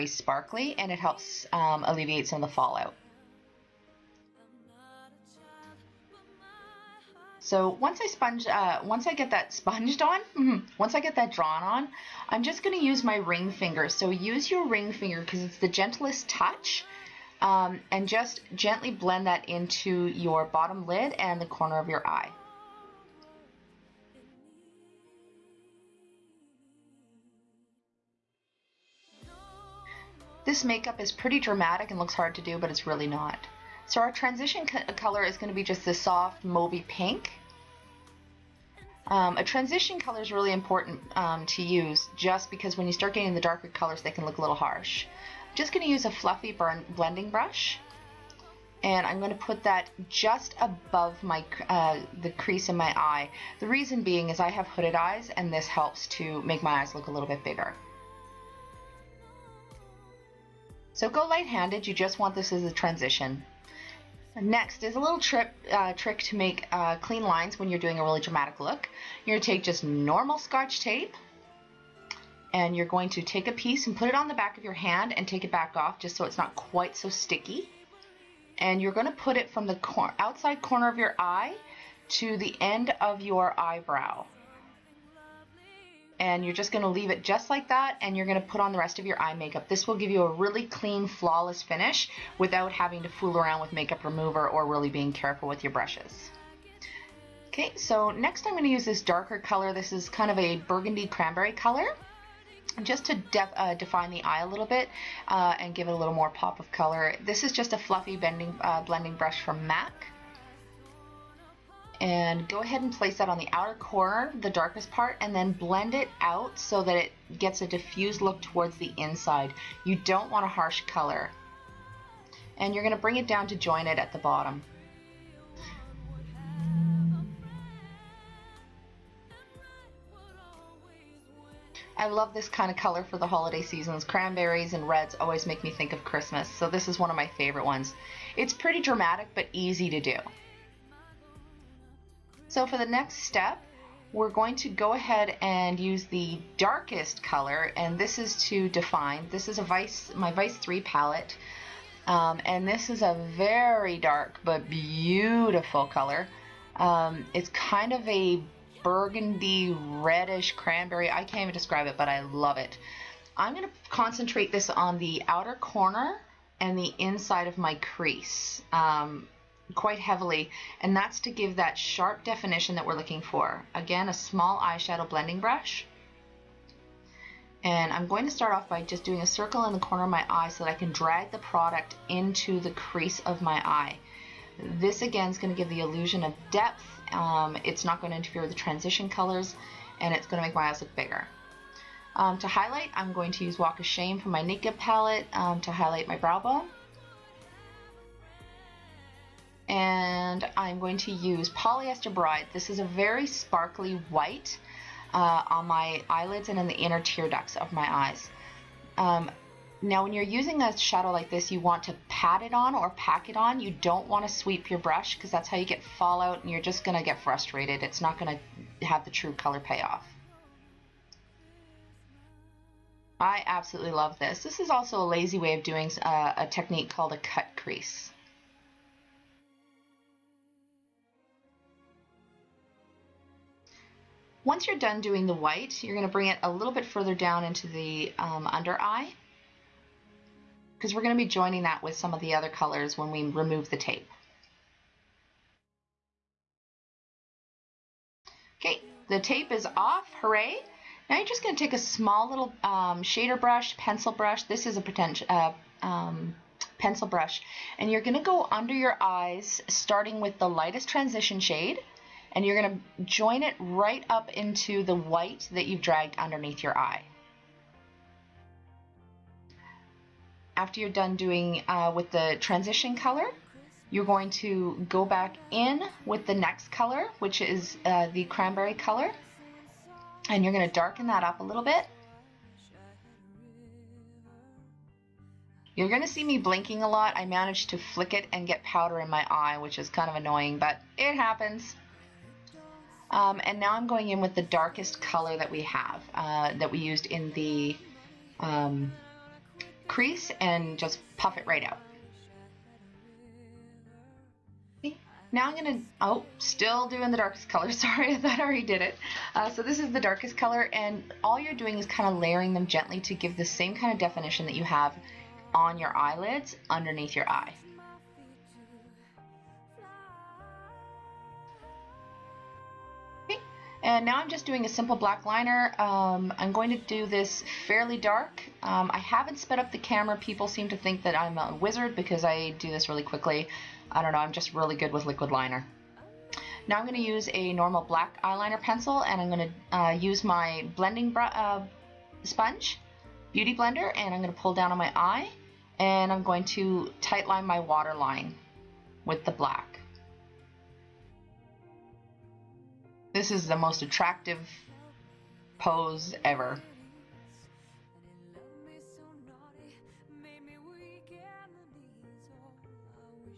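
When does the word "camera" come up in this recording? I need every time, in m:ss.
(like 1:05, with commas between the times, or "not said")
5:29.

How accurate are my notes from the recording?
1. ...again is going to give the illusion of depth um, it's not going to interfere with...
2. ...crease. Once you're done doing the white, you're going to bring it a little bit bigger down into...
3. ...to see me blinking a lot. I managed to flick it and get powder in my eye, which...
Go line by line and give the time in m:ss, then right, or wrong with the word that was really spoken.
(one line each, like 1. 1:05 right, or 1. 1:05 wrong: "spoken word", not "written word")
1. 3:05 right
2. 3:47 wrong: "further", not "bigger"
3. 4:46 right.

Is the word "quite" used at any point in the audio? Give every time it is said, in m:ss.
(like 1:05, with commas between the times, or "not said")
1:16, 2:49.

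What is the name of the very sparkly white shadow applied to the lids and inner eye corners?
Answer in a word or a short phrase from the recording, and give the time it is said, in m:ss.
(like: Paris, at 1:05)
Polyester Bride, at 3:21.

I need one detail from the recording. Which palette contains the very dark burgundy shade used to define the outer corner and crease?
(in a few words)
Vice 3.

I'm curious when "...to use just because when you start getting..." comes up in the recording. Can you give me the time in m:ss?
0:41.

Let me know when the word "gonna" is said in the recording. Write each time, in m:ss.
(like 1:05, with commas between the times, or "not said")
5:05.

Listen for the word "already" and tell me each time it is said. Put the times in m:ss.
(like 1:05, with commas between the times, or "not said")
5:08.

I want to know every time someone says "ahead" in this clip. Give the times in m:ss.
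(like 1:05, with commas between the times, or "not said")
1:52, 2:24.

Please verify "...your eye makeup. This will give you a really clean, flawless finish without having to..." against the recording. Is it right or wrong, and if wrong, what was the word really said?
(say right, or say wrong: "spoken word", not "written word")
right.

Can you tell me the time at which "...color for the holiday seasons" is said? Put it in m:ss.
2:12.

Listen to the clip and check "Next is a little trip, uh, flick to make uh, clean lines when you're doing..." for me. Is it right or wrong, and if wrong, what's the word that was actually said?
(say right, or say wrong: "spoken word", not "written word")
wrong: "trick", not "flick".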